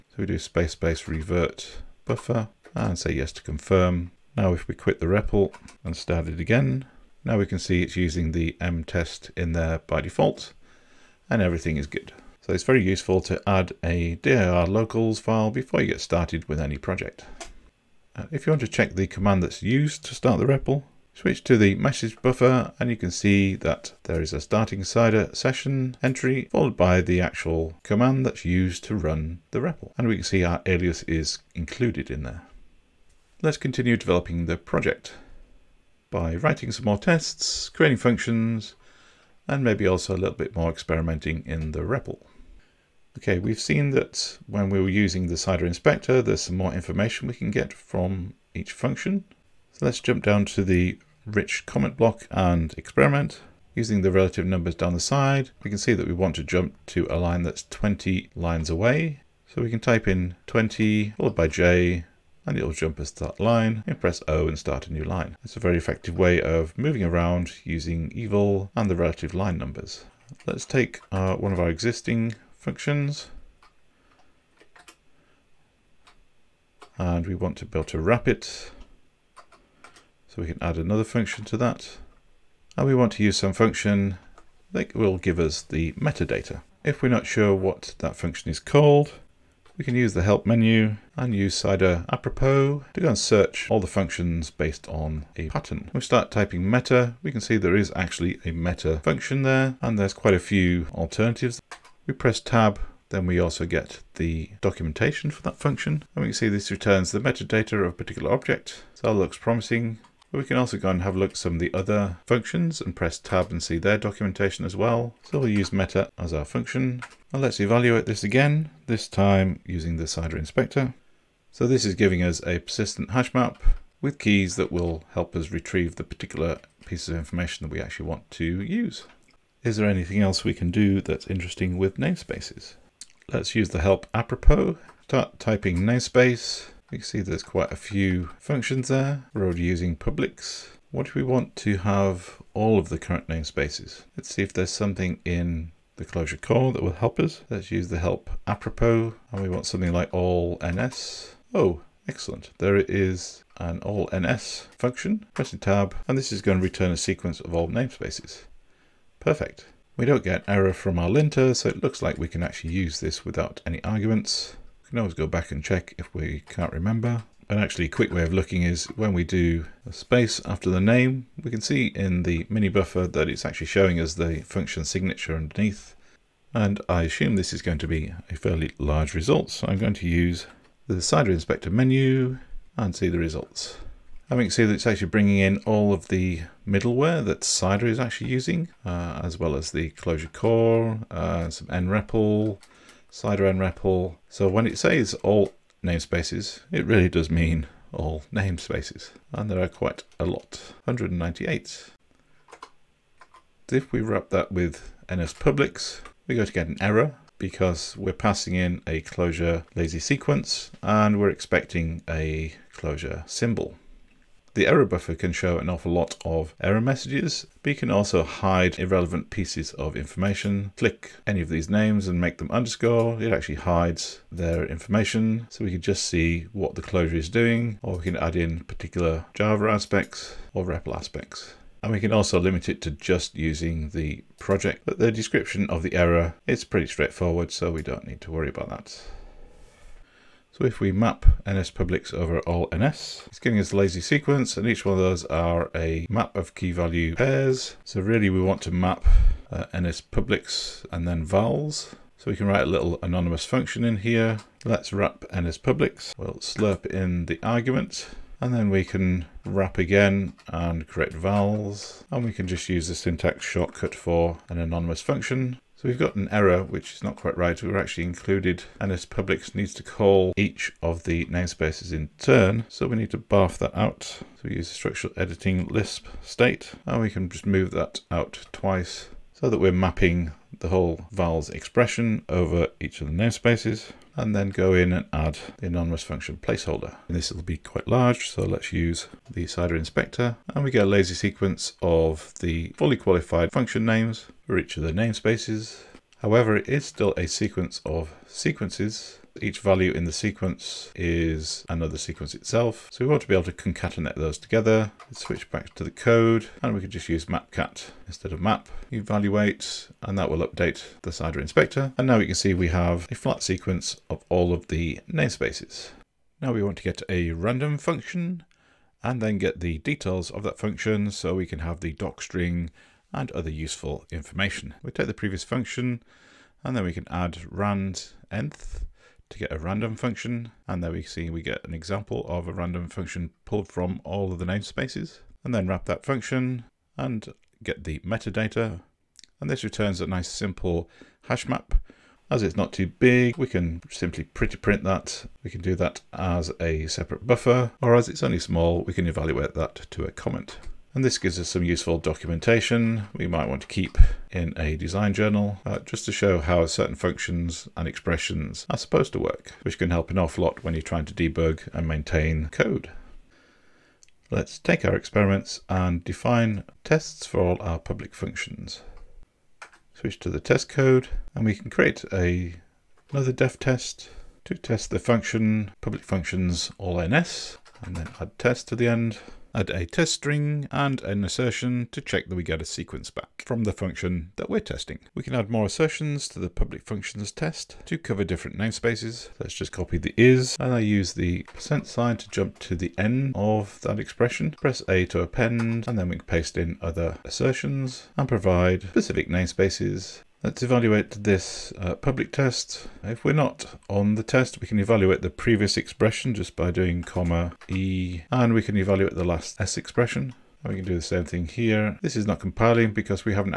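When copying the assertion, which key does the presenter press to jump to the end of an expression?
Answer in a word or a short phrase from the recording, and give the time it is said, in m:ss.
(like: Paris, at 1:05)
percent sign, at 6:31.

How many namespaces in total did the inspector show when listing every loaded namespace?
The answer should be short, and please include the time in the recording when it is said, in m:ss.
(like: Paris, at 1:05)
198, at 3:20.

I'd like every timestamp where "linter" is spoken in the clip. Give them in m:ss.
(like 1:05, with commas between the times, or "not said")
2:41.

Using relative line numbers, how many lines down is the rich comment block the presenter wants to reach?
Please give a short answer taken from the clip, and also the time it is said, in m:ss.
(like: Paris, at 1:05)
20, at 0:57.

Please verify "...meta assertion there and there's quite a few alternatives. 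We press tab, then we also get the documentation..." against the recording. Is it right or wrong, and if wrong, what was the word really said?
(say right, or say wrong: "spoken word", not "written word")
wrong: "function", not "assertion".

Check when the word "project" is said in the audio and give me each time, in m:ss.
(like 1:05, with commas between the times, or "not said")
0:16, 0:34, 3:54.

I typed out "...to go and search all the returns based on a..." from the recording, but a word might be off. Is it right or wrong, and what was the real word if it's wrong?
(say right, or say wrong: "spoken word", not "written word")
wrong: "functions", not "returns".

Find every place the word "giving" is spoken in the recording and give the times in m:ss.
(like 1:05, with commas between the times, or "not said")
2:01, 4:03.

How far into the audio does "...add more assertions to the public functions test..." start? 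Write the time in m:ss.
6:25.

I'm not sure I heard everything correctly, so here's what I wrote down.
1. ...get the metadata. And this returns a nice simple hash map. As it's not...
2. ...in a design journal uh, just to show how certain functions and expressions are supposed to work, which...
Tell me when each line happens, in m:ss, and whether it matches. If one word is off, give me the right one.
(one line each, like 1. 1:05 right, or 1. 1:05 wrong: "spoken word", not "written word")
1. 5:37 right
2. 5:54 right.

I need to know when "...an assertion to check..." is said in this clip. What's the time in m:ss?
6:21.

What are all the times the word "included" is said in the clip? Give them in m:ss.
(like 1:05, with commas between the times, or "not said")
0:31, 4:28.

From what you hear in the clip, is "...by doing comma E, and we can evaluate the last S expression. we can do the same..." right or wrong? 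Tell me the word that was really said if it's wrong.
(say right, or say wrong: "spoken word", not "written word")
right.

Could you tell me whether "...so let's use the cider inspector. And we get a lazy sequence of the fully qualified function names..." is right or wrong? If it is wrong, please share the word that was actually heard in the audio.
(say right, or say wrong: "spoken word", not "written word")
right.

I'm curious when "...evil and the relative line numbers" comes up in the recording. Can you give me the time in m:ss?
1:08.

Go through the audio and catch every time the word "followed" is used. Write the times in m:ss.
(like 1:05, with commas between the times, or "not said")
0:26, 1:01.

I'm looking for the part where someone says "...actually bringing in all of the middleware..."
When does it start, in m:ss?
3:04.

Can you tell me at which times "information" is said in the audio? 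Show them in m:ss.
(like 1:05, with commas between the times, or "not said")
0:46, 2:07, 3:39, 3:44, 5:24.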